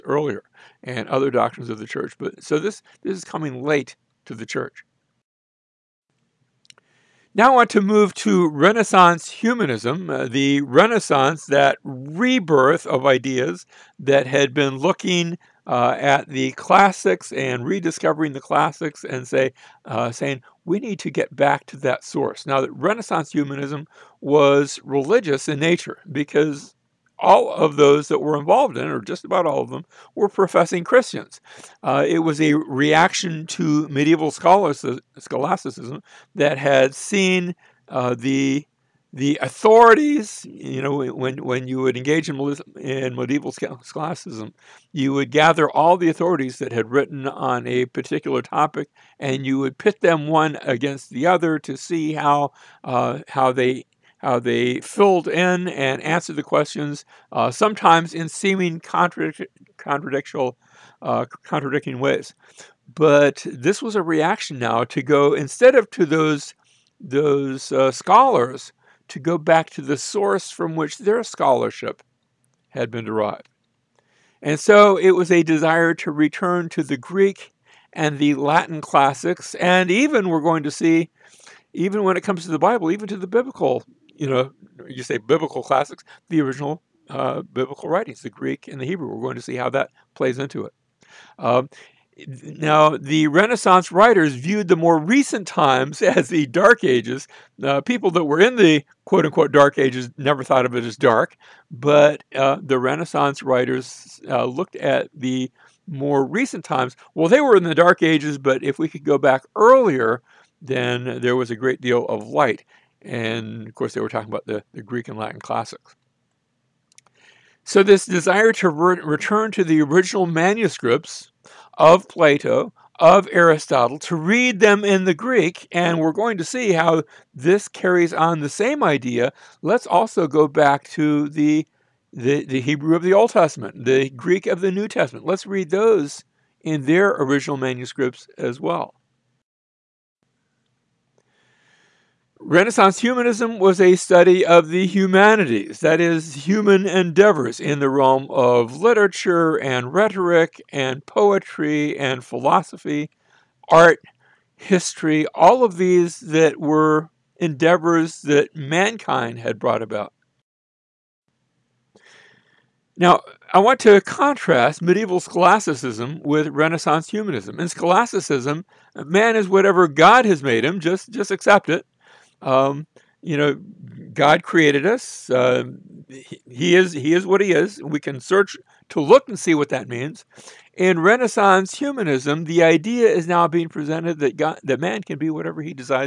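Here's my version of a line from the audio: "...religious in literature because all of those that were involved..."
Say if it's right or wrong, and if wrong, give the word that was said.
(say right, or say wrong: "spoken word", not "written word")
wrong: "nature", not "literature".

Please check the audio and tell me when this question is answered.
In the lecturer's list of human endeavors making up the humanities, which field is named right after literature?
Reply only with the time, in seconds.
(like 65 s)
149 s.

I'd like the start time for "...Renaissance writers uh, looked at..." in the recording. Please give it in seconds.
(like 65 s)
102 s.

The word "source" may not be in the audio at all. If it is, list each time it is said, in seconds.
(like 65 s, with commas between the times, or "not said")
22 s, 69 s.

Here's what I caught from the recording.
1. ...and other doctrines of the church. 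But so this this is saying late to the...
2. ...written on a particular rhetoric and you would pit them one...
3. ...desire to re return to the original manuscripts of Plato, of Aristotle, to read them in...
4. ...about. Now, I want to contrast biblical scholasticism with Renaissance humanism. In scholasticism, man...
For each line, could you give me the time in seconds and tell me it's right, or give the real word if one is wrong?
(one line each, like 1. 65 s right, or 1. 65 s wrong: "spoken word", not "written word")
1. 0 s wrong: "coming", not "saying"
2. 46 s wrong: "topic", not "rhetoric"
3. 118 s right
4. 159 s wrong: "medieval", not "biblical".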